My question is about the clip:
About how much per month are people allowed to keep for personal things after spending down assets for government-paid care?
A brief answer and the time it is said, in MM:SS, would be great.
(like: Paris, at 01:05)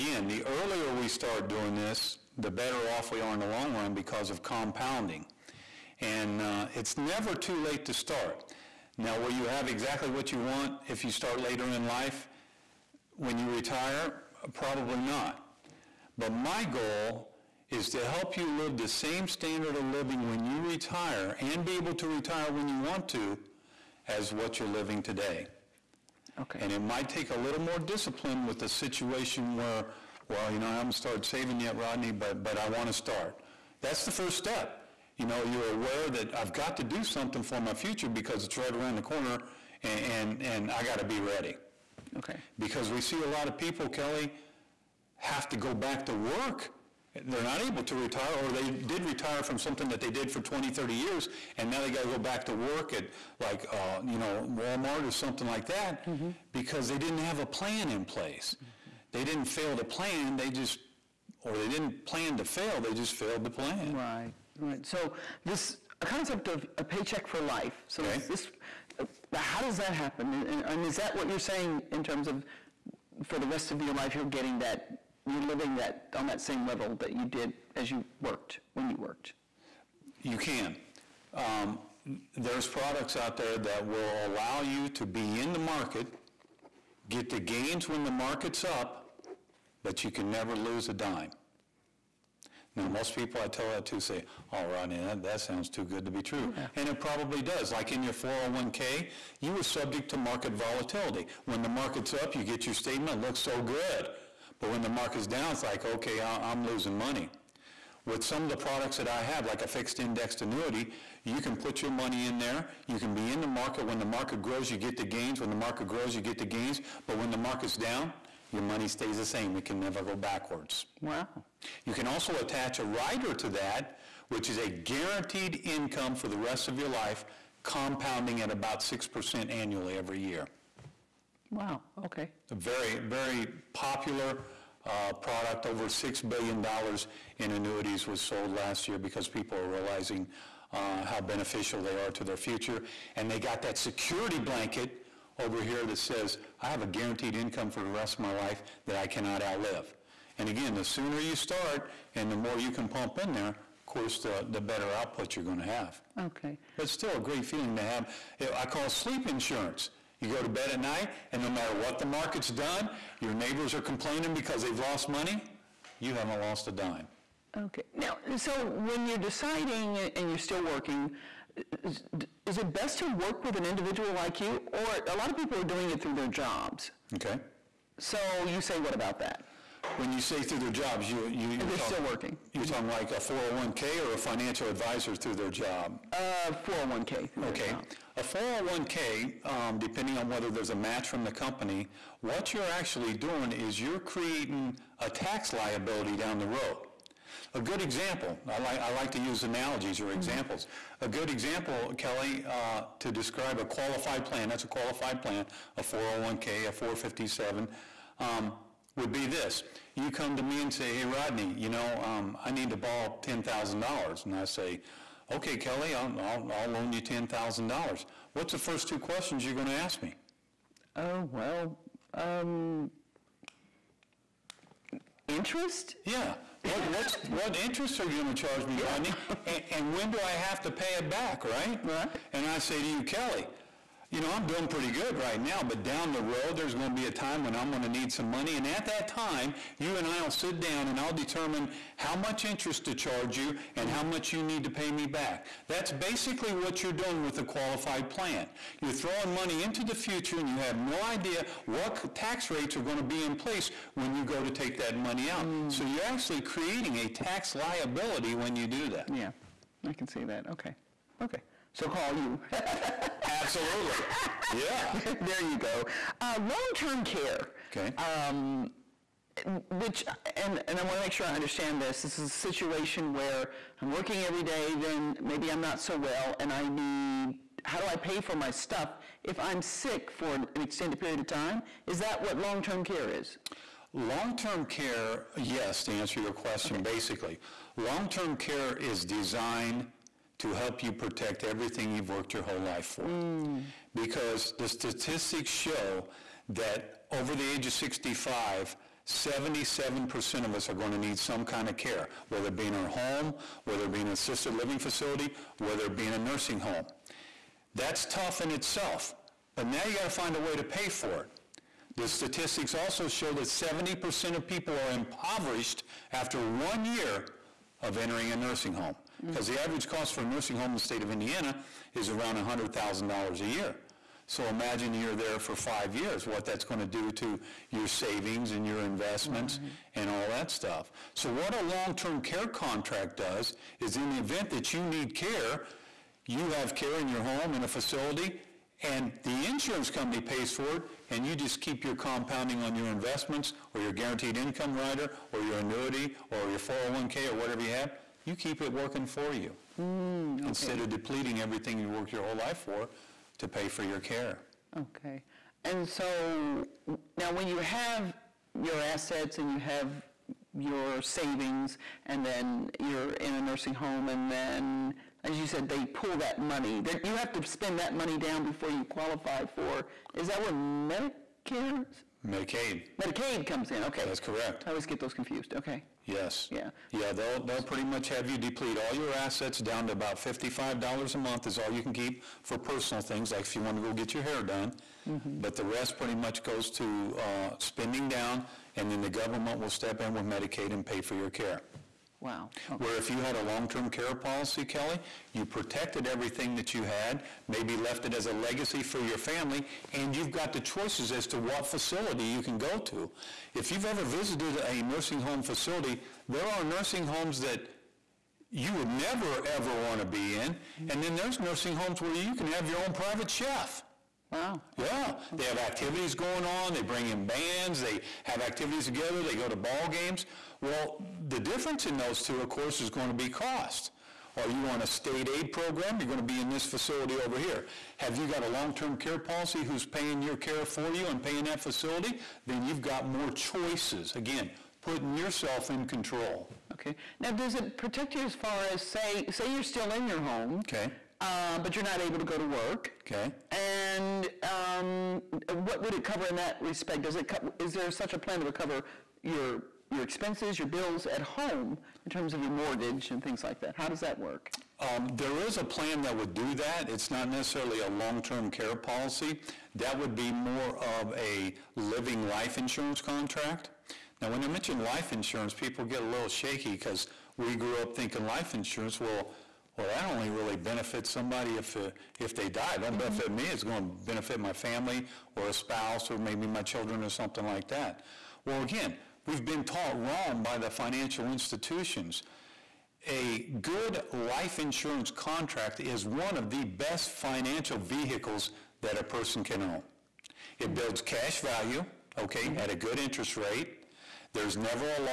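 $55, at 06:20.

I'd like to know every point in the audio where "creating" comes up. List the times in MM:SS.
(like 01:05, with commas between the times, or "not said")
03:13, 04:16.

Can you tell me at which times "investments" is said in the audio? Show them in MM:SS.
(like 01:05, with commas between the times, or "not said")
05:28, 05:42.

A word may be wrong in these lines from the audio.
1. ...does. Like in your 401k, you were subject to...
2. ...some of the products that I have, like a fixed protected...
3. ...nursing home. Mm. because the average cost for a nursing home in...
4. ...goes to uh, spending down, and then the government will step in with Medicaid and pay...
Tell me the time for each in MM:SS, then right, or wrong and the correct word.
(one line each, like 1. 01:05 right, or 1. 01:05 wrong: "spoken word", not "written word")
1. 01:37 right
2. 01:48 wrong: "indexed", not "protected"
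3. 05:18 right
4. 06:26 right.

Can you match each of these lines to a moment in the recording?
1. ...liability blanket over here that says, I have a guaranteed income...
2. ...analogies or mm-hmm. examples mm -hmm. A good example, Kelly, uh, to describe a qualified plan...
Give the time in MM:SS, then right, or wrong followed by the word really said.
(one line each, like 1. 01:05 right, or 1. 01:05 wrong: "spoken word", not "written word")
1. 02:23 wrong: "security", not "liability"
2. 03:19 right.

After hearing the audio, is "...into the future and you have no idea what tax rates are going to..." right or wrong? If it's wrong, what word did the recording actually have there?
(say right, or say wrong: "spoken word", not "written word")
right.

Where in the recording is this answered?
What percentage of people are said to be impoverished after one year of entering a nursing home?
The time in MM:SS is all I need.
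05:13.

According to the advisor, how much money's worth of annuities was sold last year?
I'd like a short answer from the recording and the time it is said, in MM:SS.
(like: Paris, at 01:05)
over $6 billion, at 02:15.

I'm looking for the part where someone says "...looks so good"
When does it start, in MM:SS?
01:43.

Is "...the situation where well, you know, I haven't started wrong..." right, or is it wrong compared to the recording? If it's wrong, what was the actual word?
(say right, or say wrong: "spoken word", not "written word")
wrong: "saving", not "wrong".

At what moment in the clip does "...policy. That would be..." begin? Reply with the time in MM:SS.
07:38.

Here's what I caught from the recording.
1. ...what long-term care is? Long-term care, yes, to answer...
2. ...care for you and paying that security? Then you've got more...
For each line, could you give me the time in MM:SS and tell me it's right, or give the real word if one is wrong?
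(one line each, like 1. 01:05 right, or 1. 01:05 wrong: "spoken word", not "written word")
1. 04:42 right
2. 07:10 wrong: "facility", not "security".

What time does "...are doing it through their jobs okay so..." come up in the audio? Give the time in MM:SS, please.
02:55.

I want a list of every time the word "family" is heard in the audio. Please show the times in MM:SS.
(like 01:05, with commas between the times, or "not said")
06:39, 07:54.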